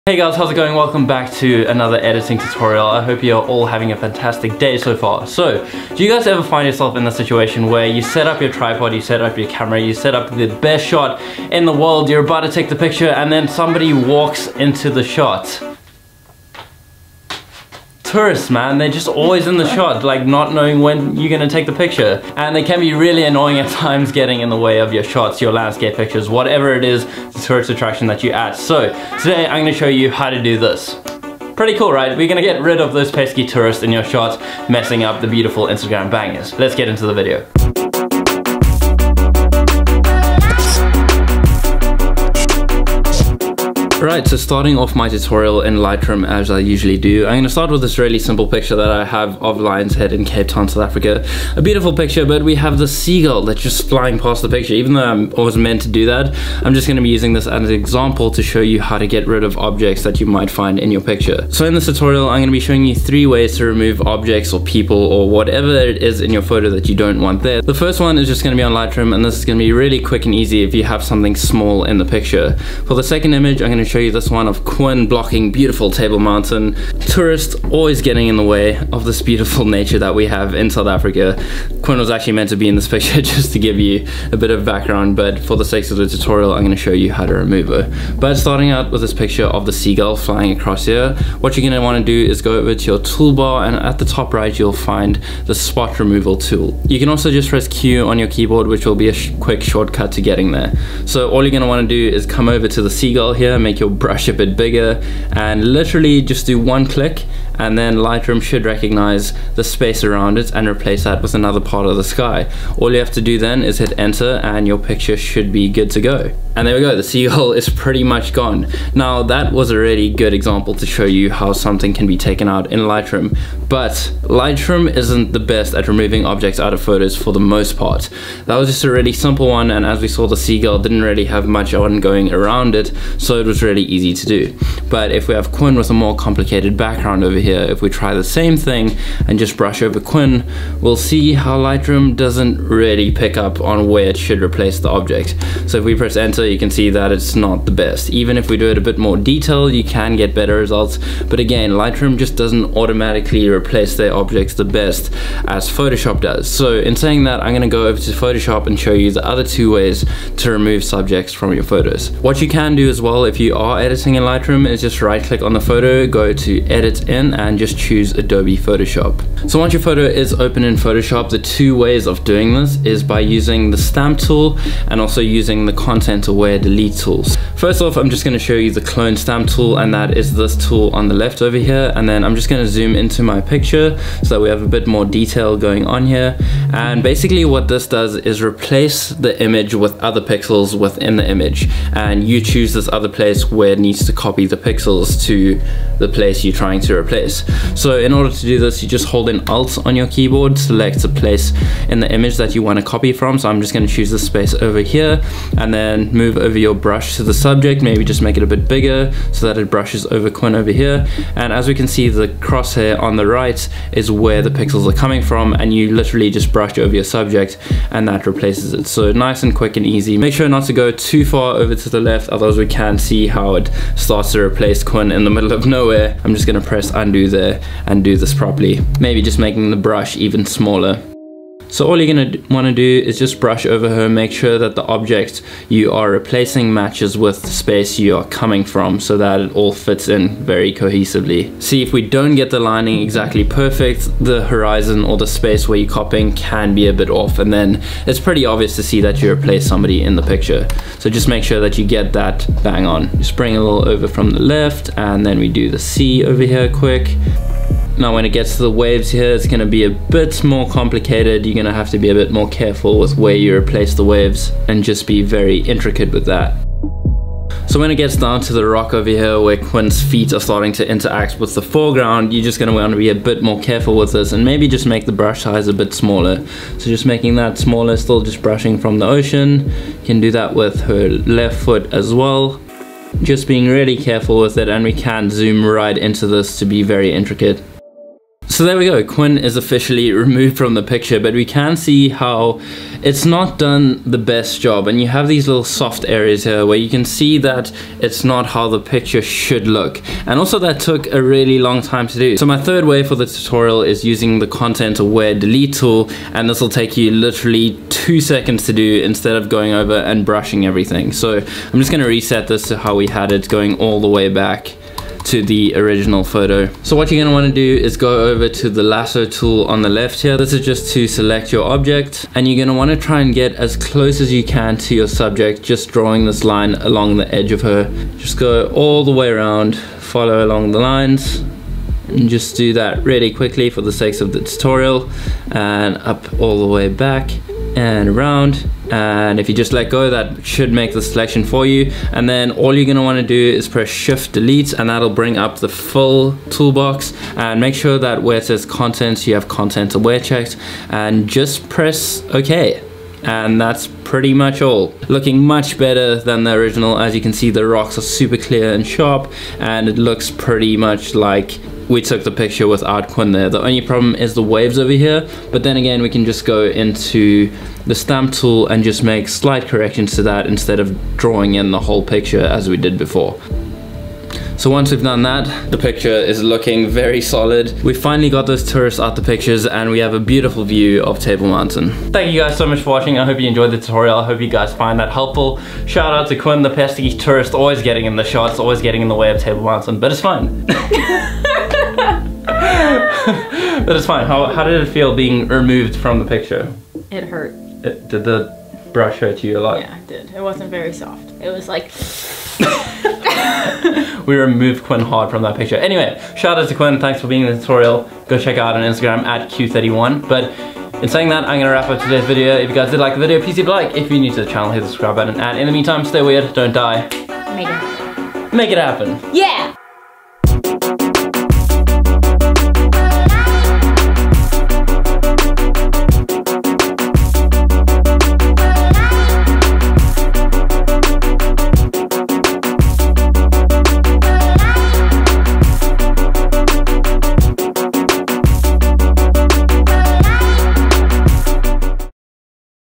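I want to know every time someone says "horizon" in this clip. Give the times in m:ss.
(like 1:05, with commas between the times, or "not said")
4:04.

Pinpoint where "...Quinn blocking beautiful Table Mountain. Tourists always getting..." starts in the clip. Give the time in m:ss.
1:14.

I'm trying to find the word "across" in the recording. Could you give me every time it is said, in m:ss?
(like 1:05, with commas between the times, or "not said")
1:30.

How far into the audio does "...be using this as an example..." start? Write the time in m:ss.
0:57.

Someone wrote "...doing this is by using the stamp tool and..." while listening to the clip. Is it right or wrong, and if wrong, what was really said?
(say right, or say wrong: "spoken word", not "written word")
right.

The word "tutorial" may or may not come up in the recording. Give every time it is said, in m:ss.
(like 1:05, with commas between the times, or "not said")
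0:02, 0:45, 1:01, 1:26, 5:03, 5:34, 6:23, 6:47.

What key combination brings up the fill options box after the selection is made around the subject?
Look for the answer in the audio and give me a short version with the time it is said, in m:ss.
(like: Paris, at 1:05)
shift delete, at 5:43.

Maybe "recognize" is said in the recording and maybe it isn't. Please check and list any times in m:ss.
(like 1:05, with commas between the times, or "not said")
1:48.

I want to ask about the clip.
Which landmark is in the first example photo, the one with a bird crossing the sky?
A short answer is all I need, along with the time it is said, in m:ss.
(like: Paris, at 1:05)
Lion's Head, at 0:49.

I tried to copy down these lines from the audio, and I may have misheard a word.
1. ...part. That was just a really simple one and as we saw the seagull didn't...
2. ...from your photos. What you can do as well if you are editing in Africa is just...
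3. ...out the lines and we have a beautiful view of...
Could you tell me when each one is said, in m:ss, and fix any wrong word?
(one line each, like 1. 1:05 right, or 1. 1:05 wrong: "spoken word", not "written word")
1. 2:07 right
2. 2:41 wrong: "Lightroom", not "Africa"
3. 6:18 wrong: "pictures", not "lines".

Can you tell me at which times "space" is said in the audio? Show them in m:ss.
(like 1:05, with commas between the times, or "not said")
1:49, 3:24, 3:57, 4:05.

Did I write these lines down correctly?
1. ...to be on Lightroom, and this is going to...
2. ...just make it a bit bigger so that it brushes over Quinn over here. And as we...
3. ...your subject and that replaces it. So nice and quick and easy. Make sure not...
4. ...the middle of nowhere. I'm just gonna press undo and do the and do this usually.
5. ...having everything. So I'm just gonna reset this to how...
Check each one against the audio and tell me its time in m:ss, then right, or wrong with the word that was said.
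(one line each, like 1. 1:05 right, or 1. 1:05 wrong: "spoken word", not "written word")
1. 1:08 right
2. 3:28 right
3. 3:36 right
4. 3:45 wrong: "properly", not "usually"
5. 5:10 wrong: "brushing", not "having".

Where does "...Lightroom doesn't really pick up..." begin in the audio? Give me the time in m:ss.
2:21.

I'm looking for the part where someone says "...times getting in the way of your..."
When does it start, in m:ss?
0:23.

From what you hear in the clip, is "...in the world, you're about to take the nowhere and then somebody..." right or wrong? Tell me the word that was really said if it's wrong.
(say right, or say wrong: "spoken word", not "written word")
wrong: "picture", not "nowhere".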